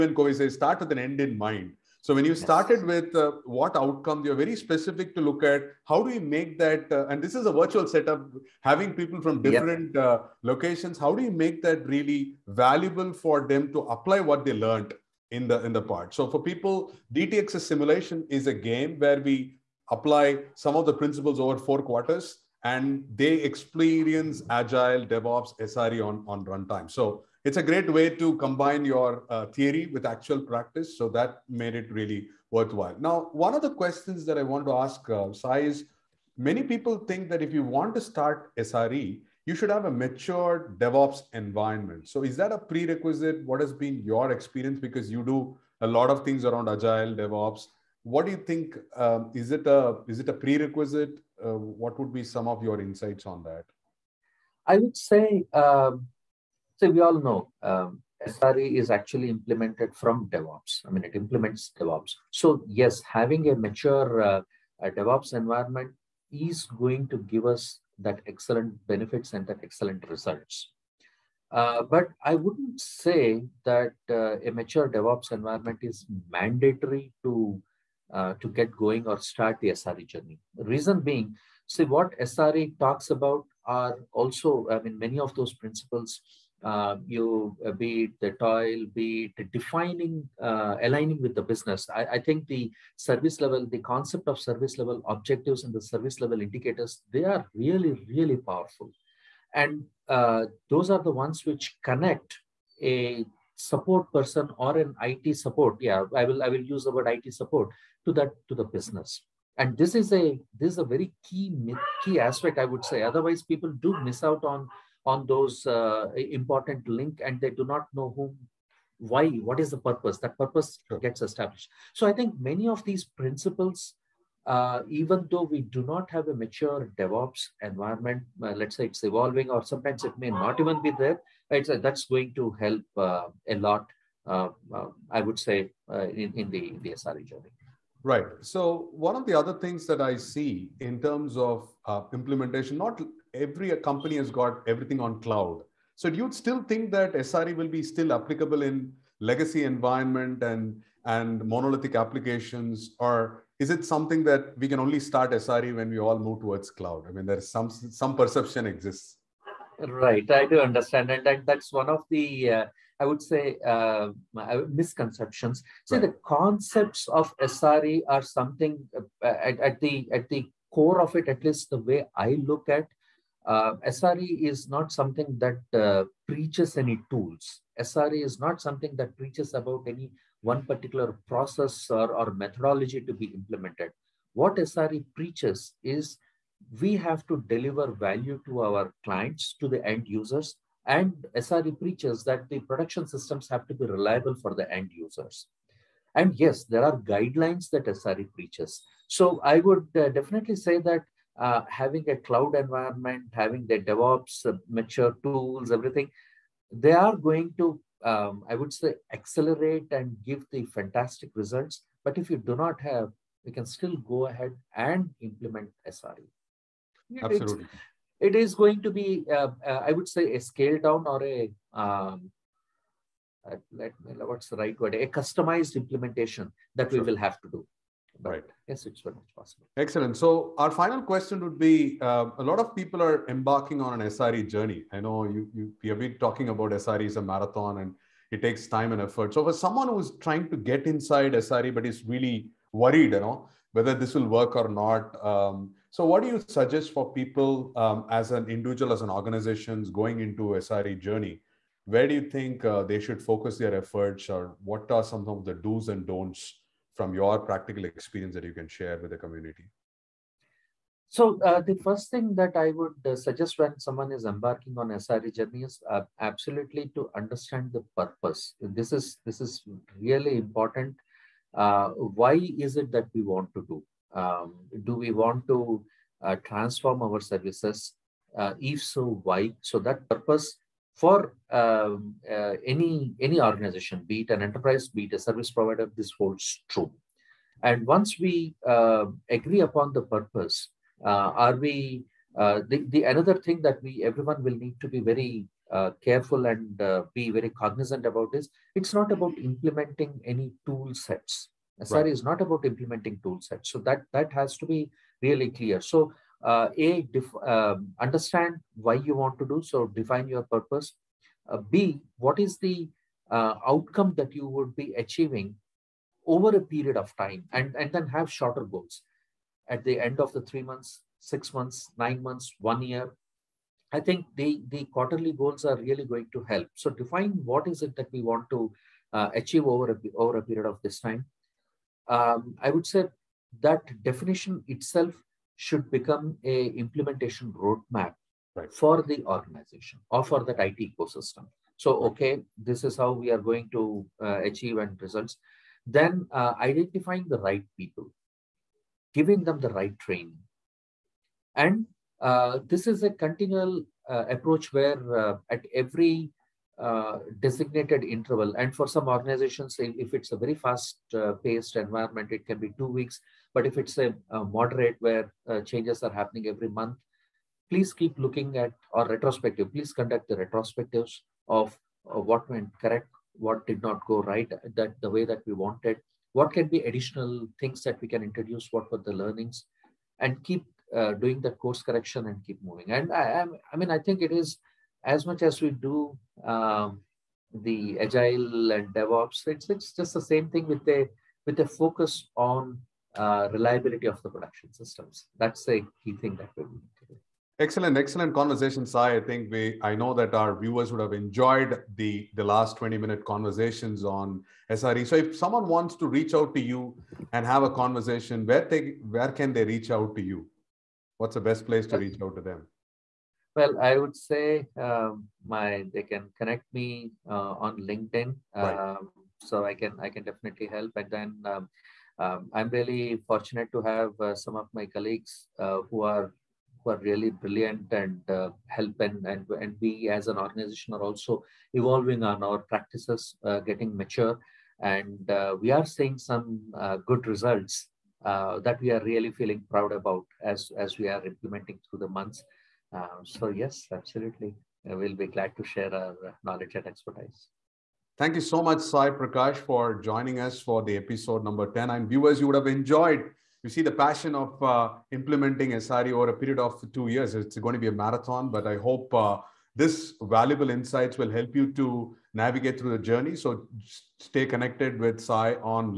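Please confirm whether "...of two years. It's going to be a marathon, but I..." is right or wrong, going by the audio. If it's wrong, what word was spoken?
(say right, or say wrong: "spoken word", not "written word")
right.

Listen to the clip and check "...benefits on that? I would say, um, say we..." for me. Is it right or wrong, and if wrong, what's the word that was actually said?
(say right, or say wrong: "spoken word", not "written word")
wrong: "insights", not "benefits".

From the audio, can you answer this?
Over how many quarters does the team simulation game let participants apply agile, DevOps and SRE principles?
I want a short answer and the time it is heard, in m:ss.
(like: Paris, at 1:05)
4, at 0:21.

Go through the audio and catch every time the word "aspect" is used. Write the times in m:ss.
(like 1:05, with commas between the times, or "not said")
1:52.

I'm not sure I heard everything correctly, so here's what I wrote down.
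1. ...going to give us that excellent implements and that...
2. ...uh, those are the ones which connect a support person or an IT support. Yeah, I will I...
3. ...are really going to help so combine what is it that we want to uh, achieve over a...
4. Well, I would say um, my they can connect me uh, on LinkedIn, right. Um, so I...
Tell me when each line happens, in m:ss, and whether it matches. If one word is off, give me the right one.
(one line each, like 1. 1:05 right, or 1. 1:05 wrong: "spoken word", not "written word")
1. 1:06 wrong: "benefits", not "implements"
2. 1:40 right
3. 5:25 wrong: "define", not "combine"
4. 6:53 right.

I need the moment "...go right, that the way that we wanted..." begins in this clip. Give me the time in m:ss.
6:14.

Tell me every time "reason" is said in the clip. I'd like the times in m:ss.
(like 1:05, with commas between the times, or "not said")
1:20.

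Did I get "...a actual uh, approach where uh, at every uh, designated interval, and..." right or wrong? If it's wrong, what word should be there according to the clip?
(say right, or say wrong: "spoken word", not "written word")
wrong: "continual", not "actual".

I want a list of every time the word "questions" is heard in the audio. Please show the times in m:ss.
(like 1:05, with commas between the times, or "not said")
0:33, 3:51.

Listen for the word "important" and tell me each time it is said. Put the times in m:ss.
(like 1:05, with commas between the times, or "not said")
1:56, 4:30.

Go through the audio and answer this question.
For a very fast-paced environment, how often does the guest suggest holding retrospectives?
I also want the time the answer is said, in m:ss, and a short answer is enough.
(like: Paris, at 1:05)
2 weeks, at 6:02.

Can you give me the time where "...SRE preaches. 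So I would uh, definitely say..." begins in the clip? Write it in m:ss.
3:17.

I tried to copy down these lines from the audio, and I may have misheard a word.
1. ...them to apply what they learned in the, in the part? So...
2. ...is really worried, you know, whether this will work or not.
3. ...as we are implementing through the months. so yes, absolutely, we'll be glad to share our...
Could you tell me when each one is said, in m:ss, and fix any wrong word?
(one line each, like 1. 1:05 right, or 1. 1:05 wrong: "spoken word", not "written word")
1. 0:13 right
2. 4:01 right
3. 7:20 right.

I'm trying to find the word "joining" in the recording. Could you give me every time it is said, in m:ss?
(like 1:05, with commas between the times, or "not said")
7:29.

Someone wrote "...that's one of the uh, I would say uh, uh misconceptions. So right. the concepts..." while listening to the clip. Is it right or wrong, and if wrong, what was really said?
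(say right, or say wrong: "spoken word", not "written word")
right.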